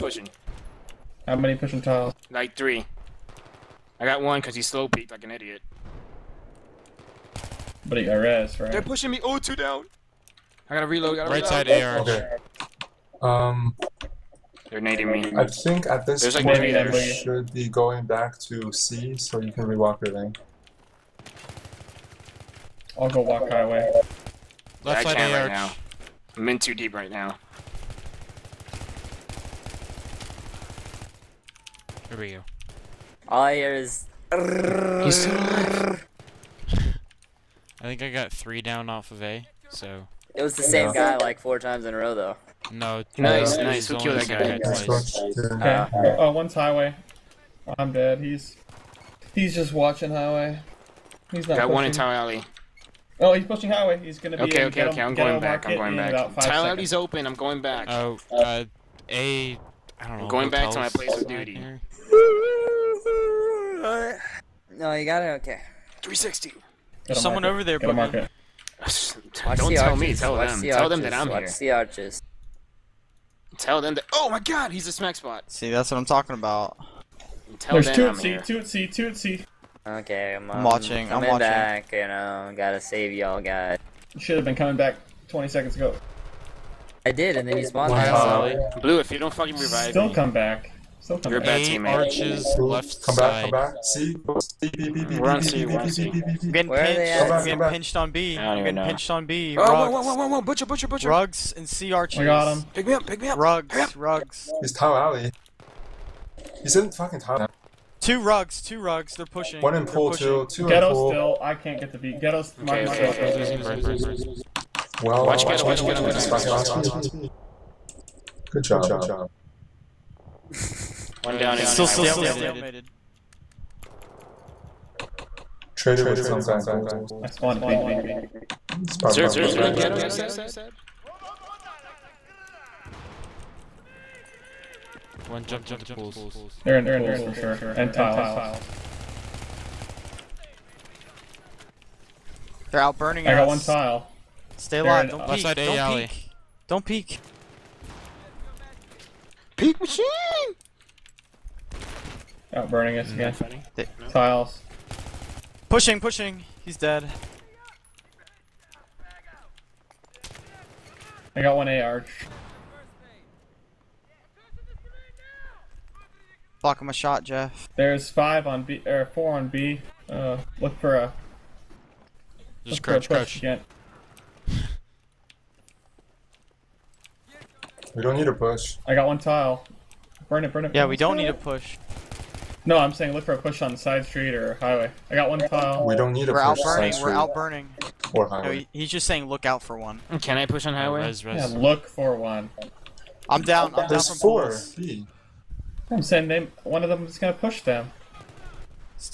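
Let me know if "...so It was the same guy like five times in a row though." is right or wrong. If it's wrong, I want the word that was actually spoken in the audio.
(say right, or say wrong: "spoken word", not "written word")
wrong: "four", not "five".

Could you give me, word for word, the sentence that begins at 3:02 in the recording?
No, I'm saying look for a push on the side street or highway.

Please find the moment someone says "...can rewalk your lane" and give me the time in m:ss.
0:19.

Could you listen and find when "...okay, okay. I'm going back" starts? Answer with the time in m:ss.
0:54.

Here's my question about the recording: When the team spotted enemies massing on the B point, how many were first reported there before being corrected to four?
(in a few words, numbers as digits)
5.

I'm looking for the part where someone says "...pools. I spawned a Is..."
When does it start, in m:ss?
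2:06.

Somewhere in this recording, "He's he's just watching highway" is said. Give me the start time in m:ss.
0:48.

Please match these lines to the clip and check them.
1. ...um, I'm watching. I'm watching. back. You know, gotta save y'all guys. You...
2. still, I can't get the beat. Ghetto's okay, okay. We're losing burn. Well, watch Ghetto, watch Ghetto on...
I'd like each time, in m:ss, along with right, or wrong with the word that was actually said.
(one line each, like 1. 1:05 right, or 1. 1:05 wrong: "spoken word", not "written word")
1. 1:20 right
2. 1:51 right.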